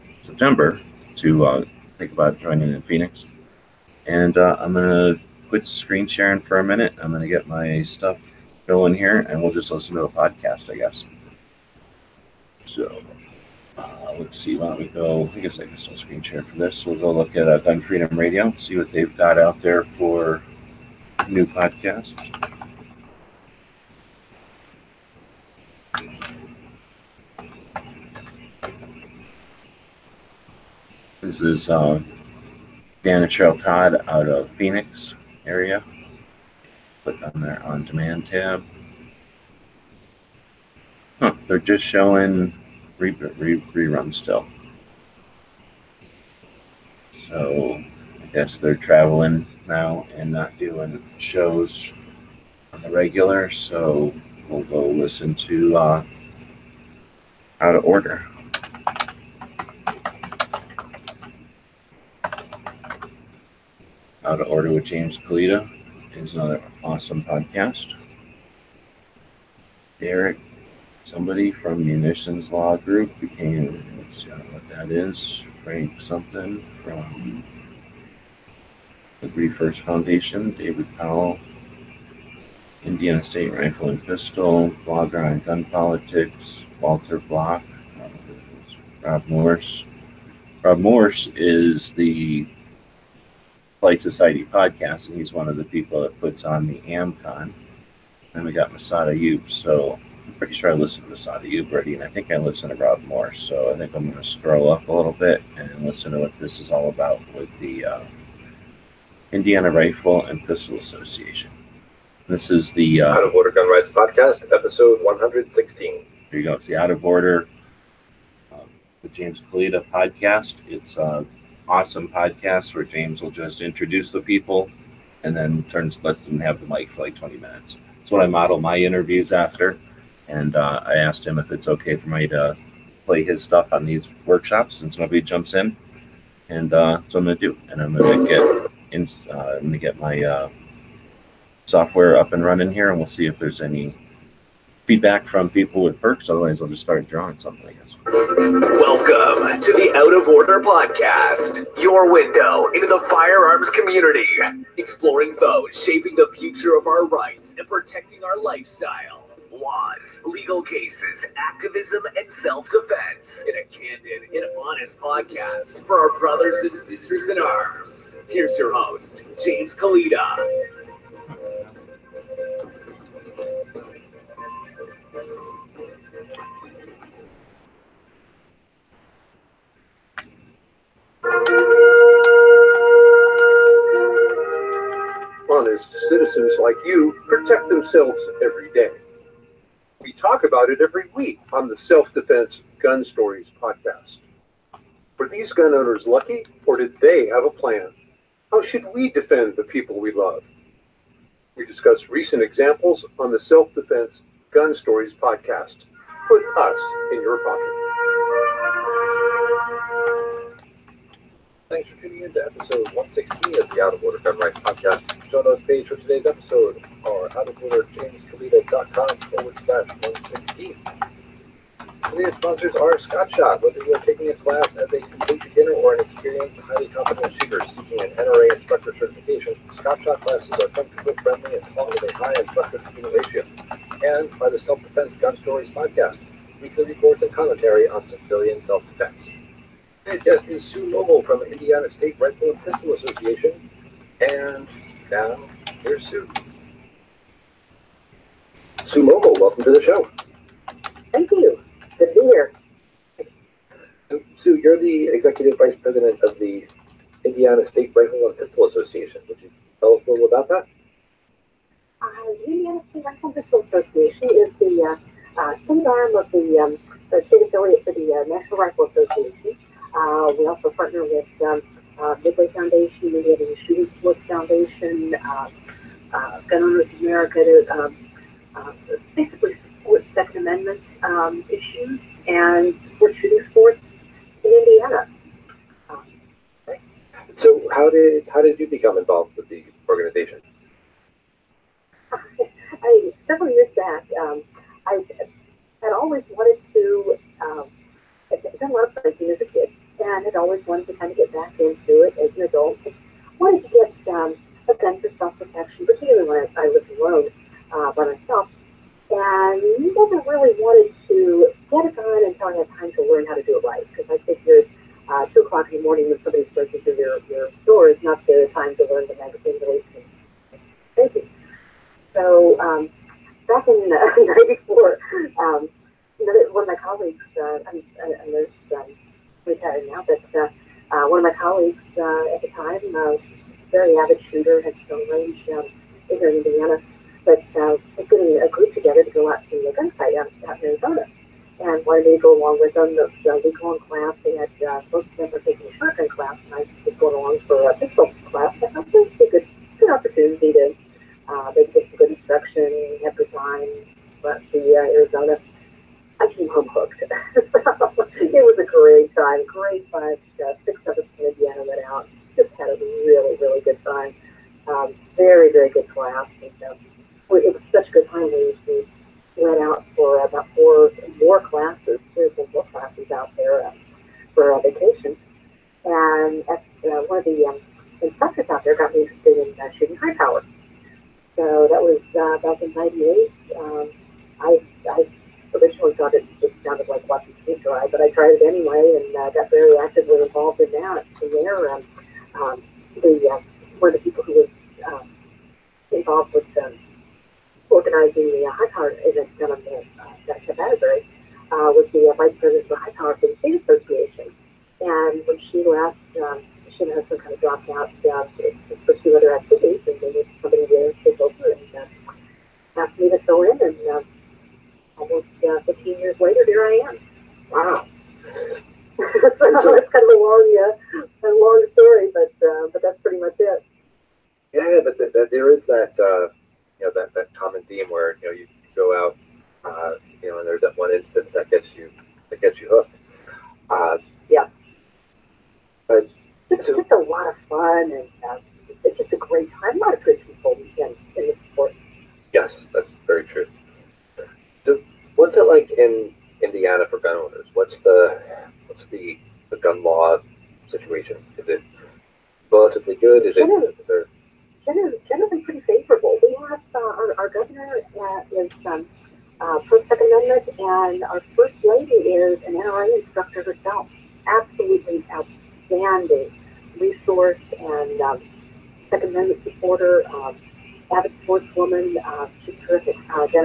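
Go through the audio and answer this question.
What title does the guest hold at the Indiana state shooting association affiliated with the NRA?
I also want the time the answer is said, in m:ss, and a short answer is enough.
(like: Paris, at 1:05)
Executive Vice President, at 4:15.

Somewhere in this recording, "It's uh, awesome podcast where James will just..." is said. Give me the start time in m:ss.
2:00.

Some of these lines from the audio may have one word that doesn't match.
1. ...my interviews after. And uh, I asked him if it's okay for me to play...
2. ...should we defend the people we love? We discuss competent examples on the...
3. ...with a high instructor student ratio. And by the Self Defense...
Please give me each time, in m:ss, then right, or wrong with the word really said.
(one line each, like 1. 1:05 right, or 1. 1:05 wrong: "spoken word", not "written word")
1. 2:08 right
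2. 3:18 wrong: "recent", not "competent"
3. 3:51 right.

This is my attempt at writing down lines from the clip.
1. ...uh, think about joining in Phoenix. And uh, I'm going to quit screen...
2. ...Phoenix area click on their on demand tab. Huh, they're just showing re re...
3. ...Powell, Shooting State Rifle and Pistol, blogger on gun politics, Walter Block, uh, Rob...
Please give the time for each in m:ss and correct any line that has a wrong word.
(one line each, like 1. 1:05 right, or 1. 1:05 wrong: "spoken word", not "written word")
1. 0:01 right
2. 0:34 right
3. 1:20 wrong: "Indiana", not "Shooting".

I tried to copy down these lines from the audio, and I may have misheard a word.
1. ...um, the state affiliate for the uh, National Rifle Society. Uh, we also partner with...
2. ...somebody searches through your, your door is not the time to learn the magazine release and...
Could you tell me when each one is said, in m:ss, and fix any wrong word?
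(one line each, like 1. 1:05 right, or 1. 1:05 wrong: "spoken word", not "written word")
1. 4:26 wrong: "Association", not "Society"
2. 5:16 right.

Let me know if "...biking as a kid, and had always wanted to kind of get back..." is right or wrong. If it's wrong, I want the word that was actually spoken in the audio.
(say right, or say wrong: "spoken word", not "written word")
right.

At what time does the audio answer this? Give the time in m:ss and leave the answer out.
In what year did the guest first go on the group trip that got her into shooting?
5:24.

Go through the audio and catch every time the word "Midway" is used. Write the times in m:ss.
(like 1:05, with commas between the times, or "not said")
4:32.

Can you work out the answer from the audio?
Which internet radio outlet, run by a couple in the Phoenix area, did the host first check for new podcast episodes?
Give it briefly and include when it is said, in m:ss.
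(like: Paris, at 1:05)
Gun Freedom Radio, at 0:17.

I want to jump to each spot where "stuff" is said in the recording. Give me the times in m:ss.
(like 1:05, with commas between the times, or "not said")
0:07, 2:13.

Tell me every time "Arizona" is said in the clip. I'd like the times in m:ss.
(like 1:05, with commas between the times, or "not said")
5:40, 5:54.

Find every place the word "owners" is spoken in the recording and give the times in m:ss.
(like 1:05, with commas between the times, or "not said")
3:15, 4:36.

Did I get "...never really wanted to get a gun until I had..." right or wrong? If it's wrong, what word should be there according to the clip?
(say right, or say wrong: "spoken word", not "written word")
right.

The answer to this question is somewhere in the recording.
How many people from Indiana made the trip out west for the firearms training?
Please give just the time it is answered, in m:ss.
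6:00.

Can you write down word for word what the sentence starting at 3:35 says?
Show notes page for today's episode are outoforderjamescalito.com forward slash 116.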